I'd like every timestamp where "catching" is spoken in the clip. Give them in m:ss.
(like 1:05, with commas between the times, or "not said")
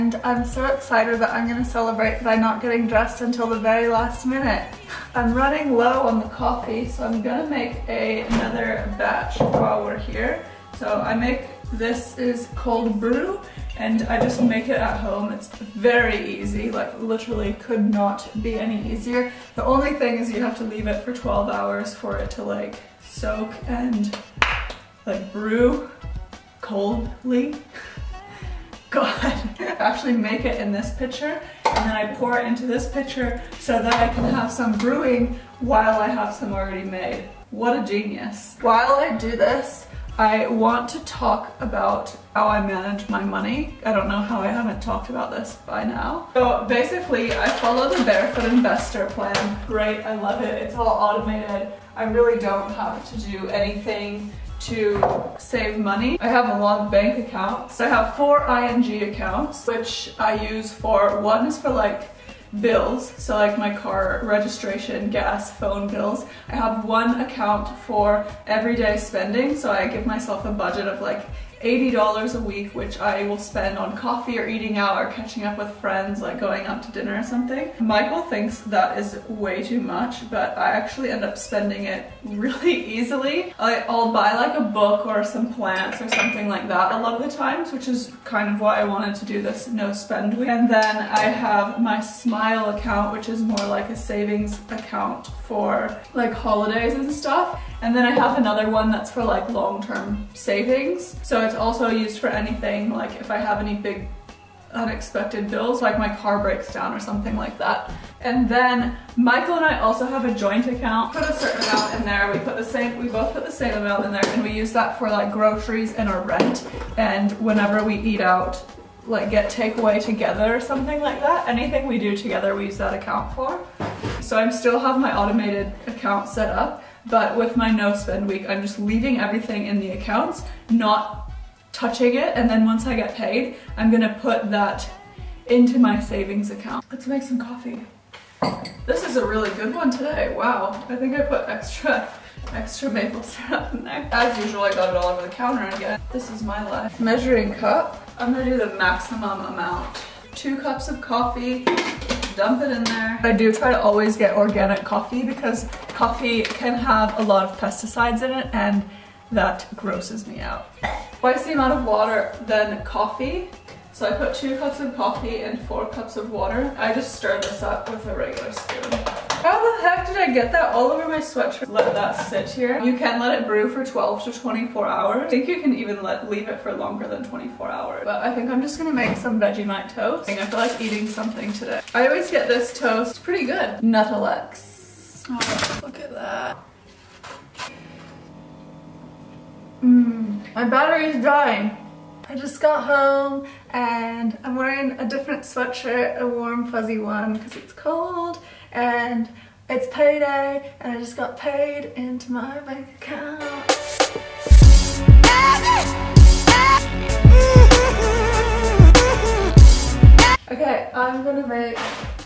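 1:15.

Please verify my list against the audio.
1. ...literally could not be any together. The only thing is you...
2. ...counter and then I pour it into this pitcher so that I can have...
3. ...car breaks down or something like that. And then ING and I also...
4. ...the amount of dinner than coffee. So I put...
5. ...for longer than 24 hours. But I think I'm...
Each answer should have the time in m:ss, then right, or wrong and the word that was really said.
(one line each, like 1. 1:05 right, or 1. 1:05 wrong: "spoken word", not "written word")
1. 0:17 wrong: "easier", not "together"
2. 0:30 wrong: "pitcher", not "counter"
3. 1:46 wrong: "Michael", not "ING"
4. 2:41 wrong: "water", not "dinner"
5. 2:56 right.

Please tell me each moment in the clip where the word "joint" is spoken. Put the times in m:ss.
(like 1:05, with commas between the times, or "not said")
1:50.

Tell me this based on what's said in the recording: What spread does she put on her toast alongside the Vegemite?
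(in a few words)
Nuttelex.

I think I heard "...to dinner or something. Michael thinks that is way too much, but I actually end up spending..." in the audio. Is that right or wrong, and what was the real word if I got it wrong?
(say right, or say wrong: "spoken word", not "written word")
right.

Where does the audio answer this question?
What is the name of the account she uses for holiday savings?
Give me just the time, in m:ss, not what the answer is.
1:31.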